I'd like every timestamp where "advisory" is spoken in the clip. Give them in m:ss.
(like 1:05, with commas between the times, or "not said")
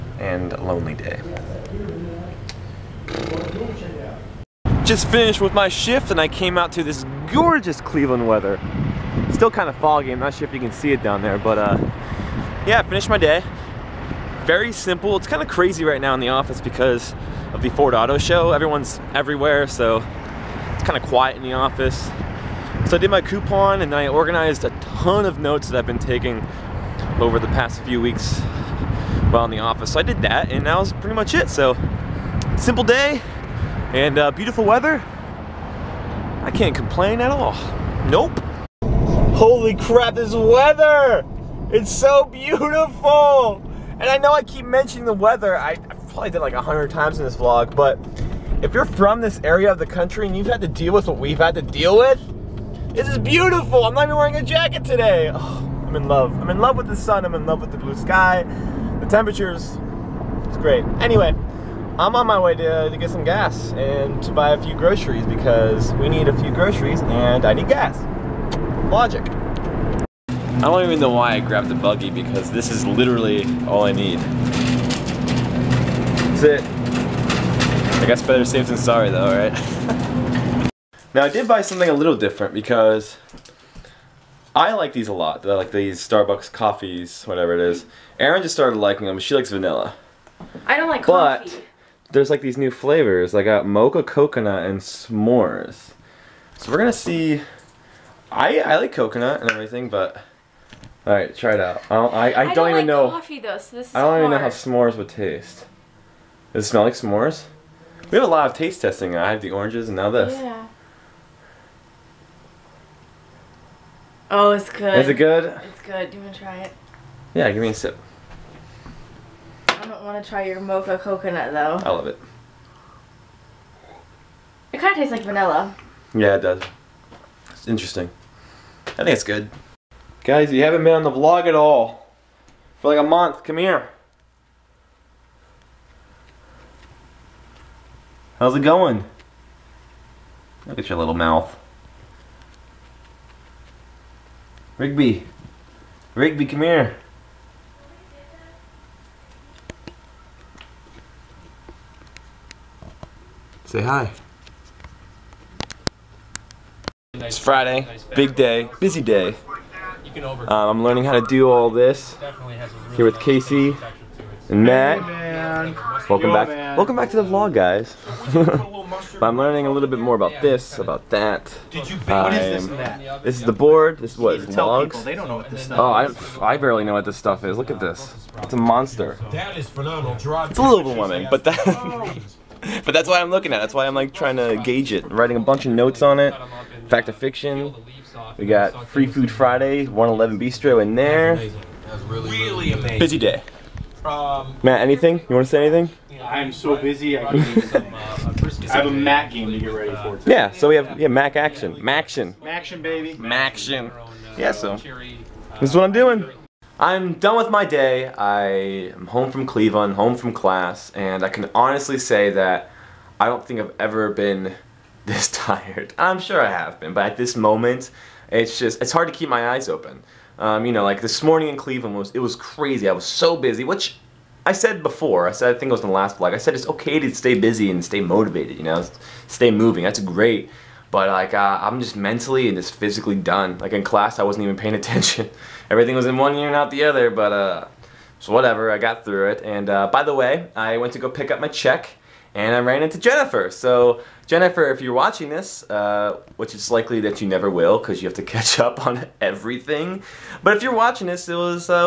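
not said.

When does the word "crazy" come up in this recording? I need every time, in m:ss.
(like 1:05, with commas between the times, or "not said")
0:15, 3:42.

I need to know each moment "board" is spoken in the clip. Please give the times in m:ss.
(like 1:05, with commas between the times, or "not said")
2:53.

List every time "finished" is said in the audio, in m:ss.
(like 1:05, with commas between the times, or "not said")
0:05, 0:12.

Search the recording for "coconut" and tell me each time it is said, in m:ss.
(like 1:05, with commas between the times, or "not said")
1:34, 1:38, 2:00.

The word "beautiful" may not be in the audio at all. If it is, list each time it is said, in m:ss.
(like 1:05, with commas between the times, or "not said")
0:34, 0:42, 0:53.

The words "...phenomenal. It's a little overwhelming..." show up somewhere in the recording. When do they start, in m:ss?
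2:59.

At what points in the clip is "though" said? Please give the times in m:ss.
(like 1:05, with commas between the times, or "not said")
1:19, 1:43, 2:01.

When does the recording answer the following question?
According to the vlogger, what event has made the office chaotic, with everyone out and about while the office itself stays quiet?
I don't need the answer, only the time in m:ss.
0:17.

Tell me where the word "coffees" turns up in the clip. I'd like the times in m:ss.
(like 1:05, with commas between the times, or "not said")
1:26, 1:31, 1:43.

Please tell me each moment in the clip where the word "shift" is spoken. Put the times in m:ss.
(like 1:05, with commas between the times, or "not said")
0:05.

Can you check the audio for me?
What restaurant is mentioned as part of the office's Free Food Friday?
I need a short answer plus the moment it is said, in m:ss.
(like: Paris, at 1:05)
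111 Bistro, at 3:09.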